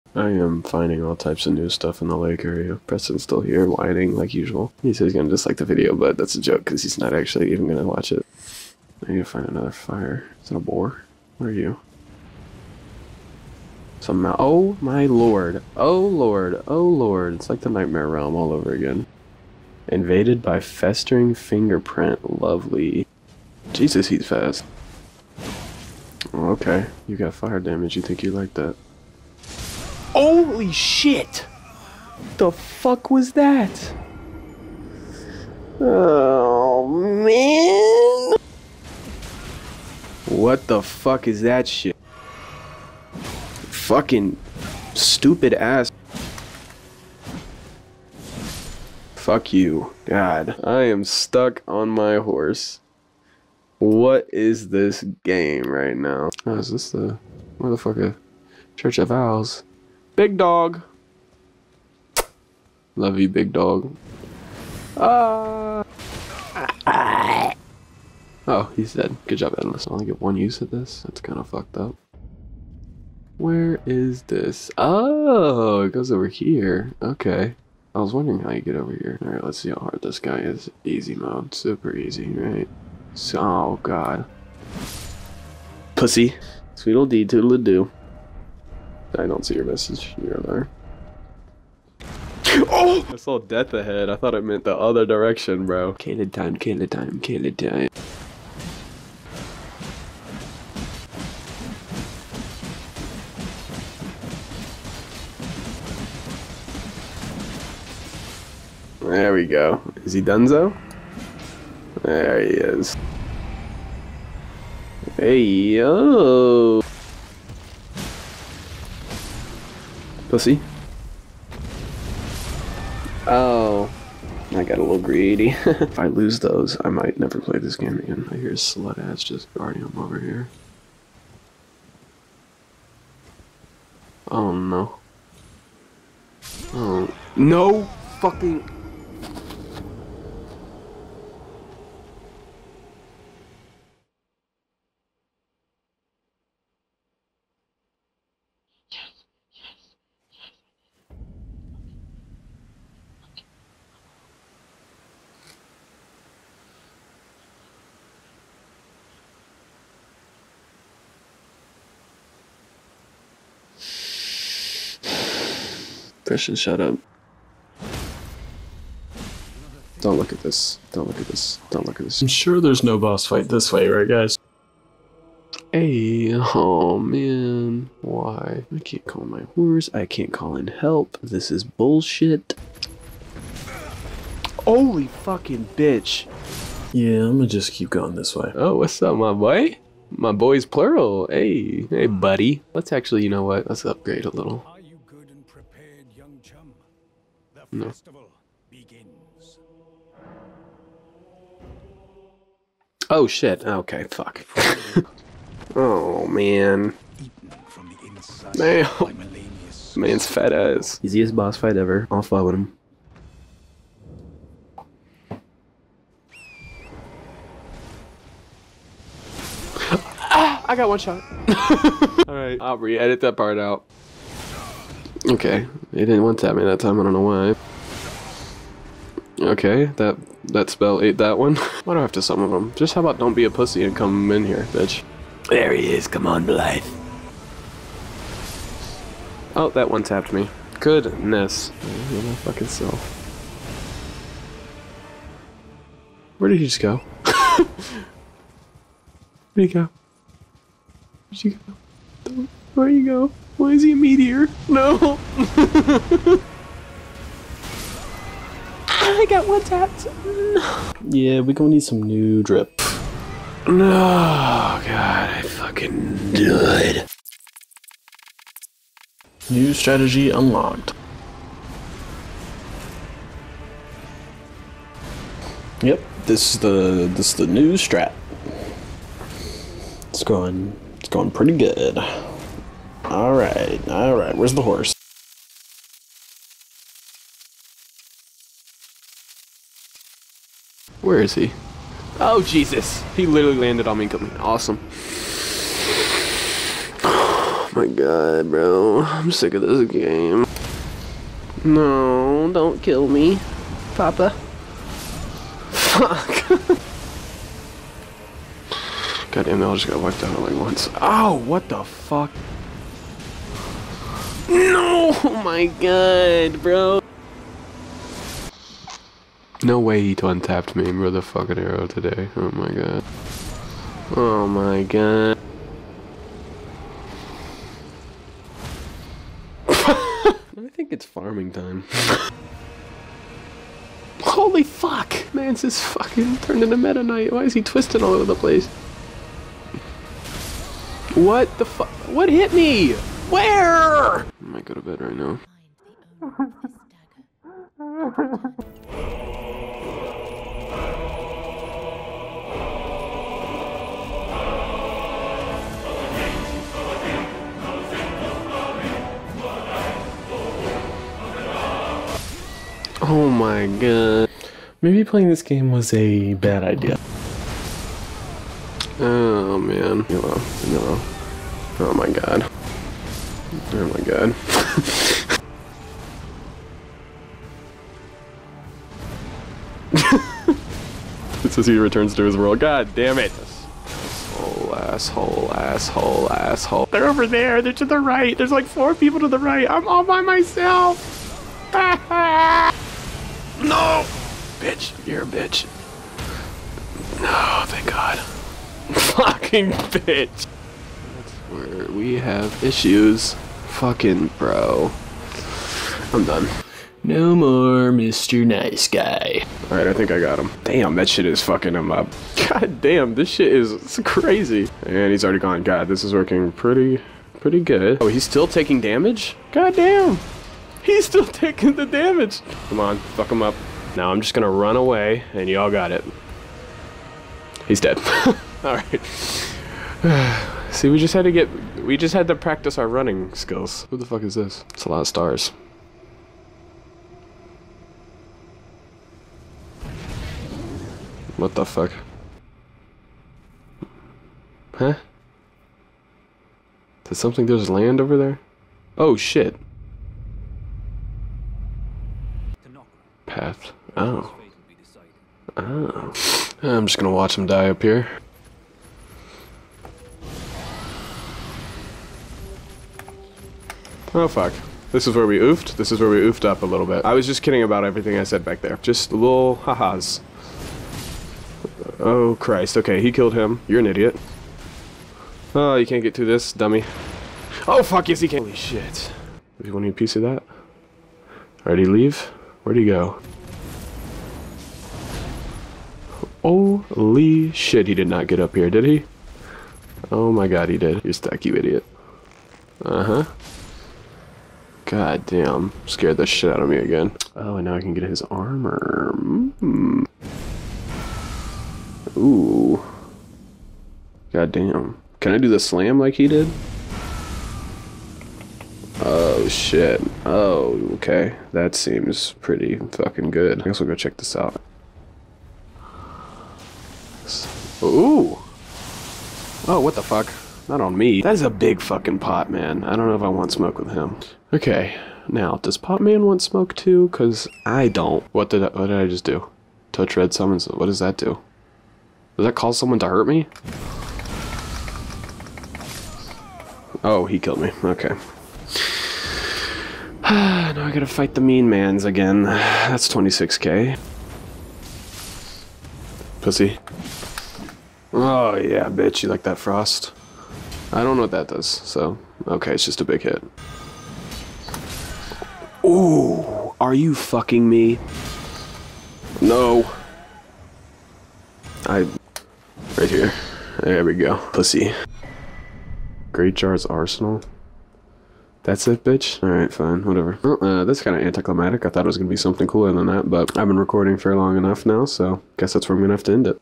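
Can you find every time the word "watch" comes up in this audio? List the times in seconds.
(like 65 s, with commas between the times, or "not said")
7 s, 457 s.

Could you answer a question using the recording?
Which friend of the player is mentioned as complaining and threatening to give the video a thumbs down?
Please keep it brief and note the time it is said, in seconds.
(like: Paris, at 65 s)
Preston, at 2 s.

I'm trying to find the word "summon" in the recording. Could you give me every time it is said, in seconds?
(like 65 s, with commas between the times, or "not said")
232 s, 530 s.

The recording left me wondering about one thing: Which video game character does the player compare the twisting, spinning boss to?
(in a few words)
Meta Knight.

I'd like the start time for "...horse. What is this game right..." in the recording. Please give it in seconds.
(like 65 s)
52 s.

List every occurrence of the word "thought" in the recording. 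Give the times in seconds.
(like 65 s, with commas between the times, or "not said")
94 s, 571 s.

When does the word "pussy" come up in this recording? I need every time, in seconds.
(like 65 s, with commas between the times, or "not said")
85 s, 120 s, 233 s, 546 s, 564 s.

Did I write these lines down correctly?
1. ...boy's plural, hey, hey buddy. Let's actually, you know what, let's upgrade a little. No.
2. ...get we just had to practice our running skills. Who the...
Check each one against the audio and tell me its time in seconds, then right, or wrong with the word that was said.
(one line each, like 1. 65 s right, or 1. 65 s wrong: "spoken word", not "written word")
1. 190 s right
2. 431 s right.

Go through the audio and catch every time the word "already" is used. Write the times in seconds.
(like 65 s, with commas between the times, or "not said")
415 s, 481 s.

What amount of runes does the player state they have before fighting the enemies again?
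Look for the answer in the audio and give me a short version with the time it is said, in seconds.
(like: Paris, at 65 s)
26k, at 543 s.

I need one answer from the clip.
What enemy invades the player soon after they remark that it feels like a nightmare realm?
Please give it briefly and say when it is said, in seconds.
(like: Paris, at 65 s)
Festering fingerprint, at 20 s.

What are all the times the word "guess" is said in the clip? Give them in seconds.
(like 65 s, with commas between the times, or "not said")
513 s, 575 s.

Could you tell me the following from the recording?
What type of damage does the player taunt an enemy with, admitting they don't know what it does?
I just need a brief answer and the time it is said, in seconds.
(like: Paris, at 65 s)
Frost, at 549 s.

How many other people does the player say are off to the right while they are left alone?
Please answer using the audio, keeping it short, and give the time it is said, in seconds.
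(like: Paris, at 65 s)
4, at 388 s.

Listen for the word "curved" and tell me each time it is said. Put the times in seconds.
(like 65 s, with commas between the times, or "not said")
not said.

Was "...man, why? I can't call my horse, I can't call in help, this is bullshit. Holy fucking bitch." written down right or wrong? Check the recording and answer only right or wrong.
right.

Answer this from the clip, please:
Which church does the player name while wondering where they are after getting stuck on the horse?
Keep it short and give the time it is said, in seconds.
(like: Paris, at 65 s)
Church of Vows, at 58 s.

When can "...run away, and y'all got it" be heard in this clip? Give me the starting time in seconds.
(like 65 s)
424 s.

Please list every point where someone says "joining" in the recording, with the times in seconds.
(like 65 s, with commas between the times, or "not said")
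not said.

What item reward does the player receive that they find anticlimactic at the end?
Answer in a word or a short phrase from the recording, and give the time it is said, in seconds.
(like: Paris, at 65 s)
Great Jar's Arsenal, at 566 s.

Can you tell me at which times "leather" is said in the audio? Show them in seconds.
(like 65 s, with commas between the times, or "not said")
not said.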